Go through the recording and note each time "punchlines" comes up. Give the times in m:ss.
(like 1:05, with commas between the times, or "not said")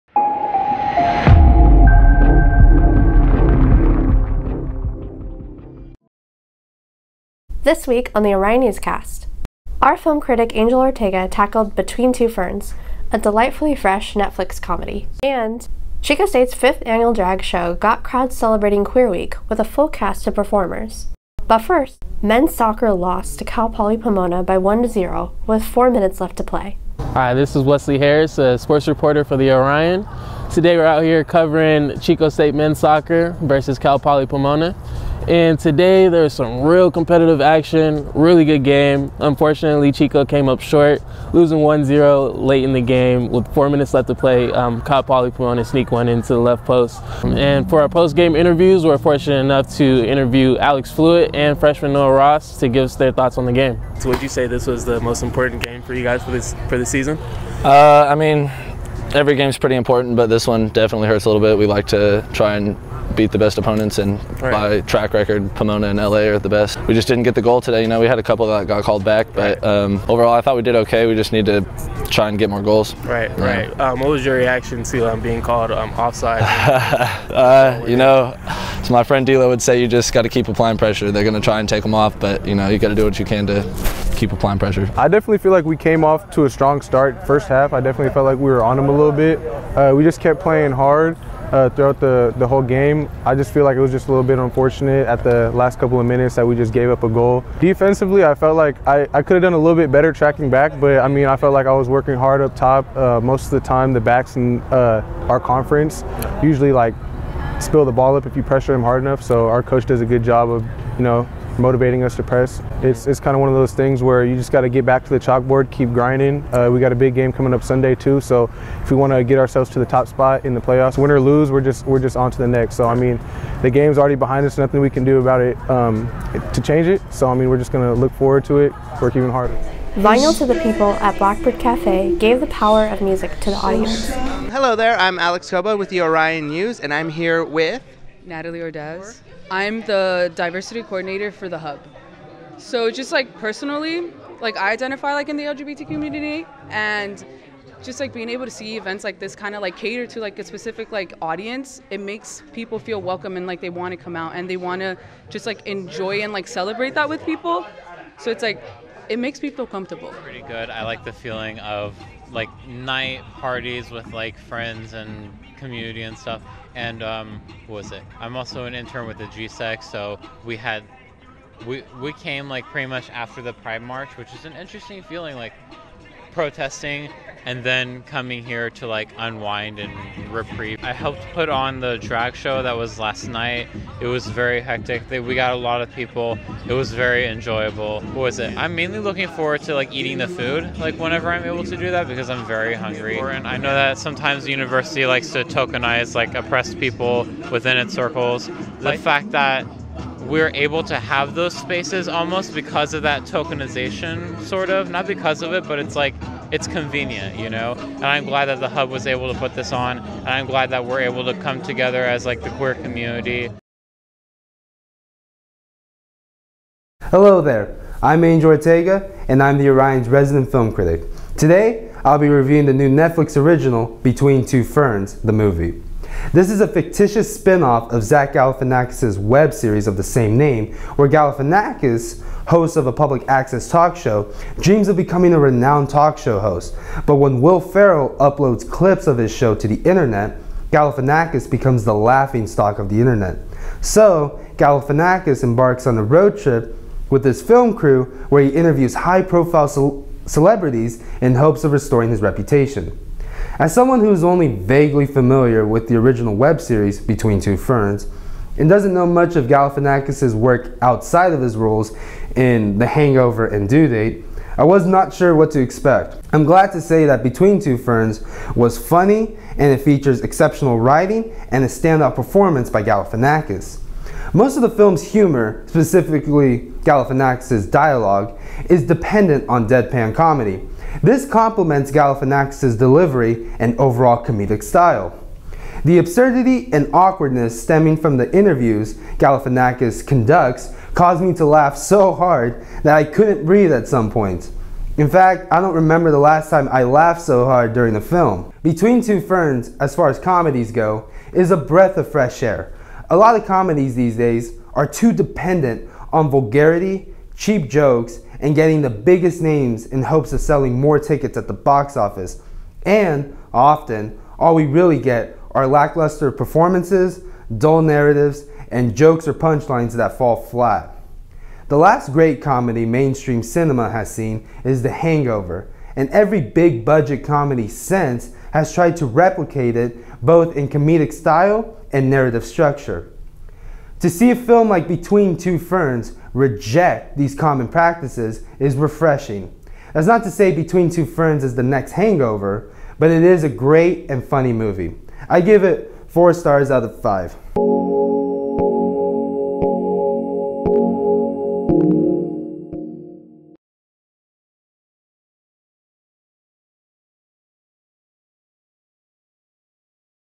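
5:19.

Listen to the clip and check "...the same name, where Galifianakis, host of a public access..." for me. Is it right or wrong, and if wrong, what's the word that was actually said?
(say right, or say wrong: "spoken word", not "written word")
right.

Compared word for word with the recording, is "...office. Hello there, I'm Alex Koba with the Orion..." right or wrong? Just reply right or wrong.
wrong.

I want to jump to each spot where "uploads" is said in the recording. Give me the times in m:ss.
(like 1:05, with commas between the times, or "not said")
3:58.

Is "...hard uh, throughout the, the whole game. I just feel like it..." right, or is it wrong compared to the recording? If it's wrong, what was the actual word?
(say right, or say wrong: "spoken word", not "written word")
right.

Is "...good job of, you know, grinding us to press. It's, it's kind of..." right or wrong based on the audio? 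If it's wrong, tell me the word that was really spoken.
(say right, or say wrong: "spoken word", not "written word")
wrong: "motivating", not "grinding".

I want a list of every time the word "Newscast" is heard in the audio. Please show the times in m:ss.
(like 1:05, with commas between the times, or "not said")
0:08.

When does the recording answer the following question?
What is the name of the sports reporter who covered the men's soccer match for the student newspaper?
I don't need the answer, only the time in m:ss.
0:27.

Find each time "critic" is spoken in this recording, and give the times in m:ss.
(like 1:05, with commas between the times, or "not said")
0:10, 3:40.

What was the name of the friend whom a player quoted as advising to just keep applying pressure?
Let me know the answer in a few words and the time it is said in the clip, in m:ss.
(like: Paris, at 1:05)
Dilo, at 1:19.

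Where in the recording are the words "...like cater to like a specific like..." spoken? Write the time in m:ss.
2:29.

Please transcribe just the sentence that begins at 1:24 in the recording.
I definitely feel like we came off to a strong start first half.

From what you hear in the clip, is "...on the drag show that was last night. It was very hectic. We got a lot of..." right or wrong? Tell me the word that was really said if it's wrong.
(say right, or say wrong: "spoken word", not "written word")
right.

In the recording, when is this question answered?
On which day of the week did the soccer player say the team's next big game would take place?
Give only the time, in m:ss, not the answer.
1:57.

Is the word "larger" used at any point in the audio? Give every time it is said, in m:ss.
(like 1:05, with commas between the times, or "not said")
not said.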